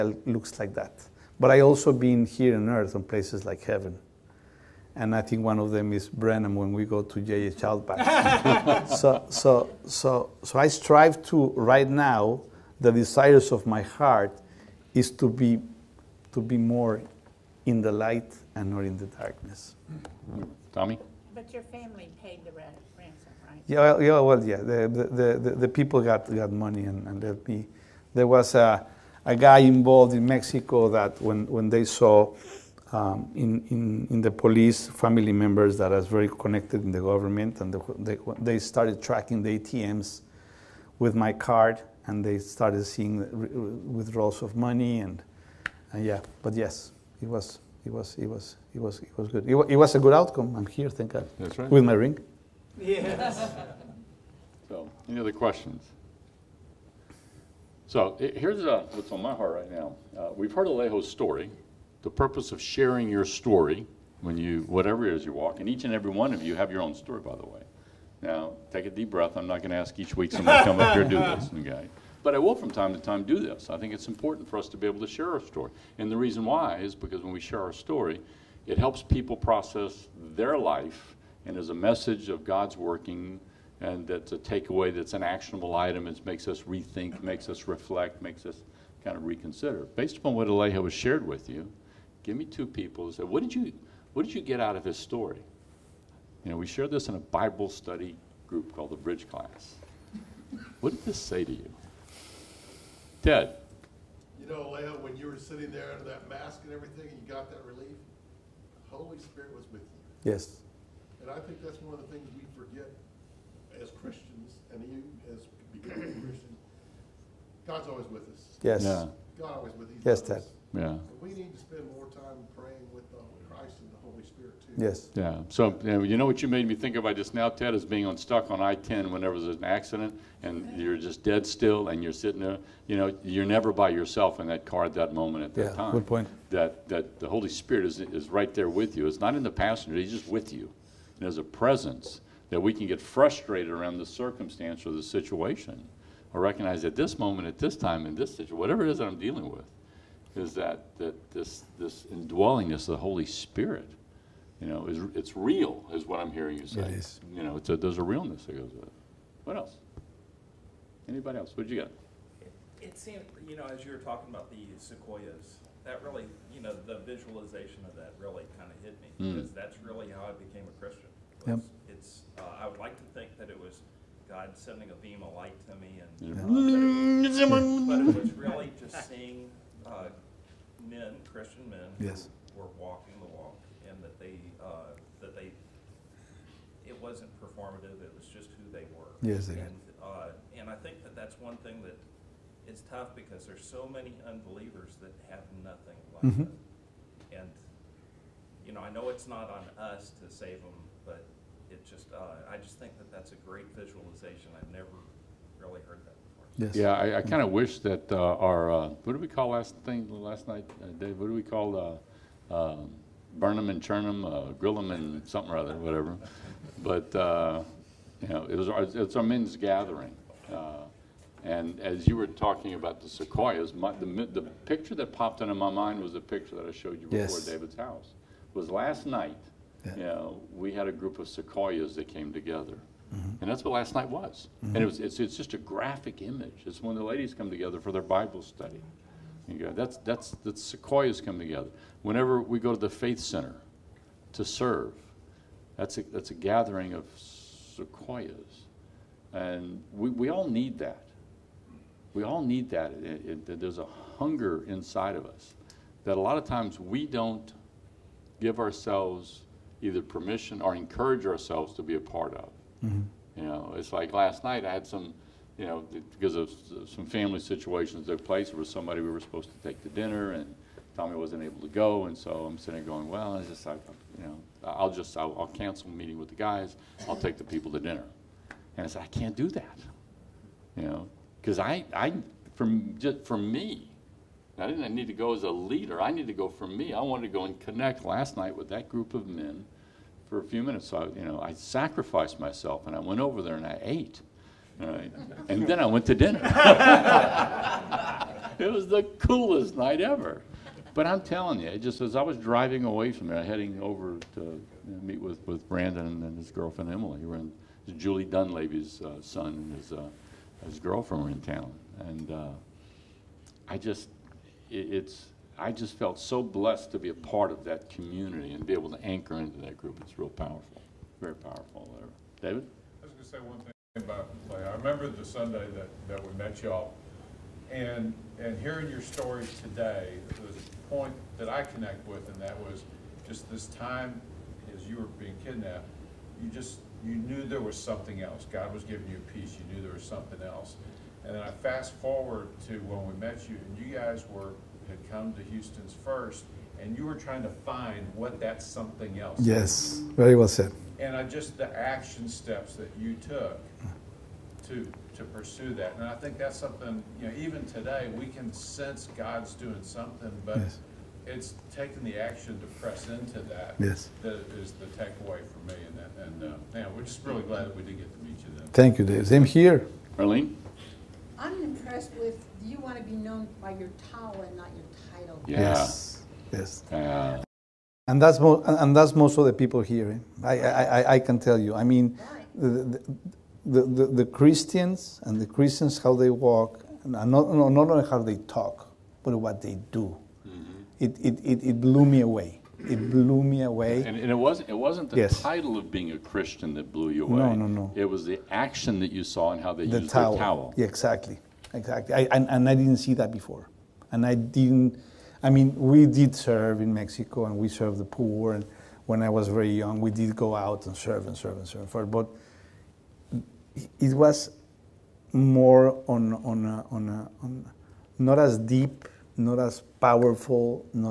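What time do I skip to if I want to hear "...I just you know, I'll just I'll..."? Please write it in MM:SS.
04:33.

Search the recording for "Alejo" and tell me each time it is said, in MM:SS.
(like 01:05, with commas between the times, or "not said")
01:00, 01:30.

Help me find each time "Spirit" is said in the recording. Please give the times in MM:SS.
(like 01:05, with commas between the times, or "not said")
01:49, 02:04, 02:17, 02:33.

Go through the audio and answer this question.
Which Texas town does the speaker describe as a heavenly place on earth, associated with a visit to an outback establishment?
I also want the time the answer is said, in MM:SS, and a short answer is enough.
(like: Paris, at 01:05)
Brenham, at 00:06.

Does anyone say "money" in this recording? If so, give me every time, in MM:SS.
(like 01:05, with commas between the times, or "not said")
00:26, 00:44.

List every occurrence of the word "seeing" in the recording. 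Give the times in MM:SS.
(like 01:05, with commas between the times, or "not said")
00:42, 02:59.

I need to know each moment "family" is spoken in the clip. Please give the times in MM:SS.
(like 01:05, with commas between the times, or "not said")
00:21, 00:34, 04:27.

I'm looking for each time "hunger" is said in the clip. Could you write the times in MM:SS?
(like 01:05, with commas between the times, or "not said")
04:14.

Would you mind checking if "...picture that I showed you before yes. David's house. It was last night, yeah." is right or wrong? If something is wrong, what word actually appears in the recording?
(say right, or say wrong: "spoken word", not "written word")
right.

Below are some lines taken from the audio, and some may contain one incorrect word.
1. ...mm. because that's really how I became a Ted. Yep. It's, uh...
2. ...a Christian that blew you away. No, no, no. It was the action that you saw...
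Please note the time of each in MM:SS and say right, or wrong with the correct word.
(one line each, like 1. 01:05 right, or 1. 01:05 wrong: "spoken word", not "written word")
1. 02:49 wrong: "Christian", not "Ted"
2. 06:36 right.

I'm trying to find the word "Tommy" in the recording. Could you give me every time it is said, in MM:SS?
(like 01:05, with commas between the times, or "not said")
00:20, 04:30.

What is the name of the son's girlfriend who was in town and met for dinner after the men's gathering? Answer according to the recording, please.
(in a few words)
Emily.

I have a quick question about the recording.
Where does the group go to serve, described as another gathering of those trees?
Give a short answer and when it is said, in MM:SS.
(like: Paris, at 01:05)
Faith Center, at 04:02.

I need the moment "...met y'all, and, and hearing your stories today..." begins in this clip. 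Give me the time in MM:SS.
05:26.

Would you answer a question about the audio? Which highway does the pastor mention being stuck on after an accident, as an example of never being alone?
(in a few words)
I-10.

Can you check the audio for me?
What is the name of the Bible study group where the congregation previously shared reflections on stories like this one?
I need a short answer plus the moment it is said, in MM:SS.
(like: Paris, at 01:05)
Bridge Class, at 01:38.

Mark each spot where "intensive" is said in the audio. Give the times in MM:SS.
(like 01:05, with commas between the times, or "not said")
not said.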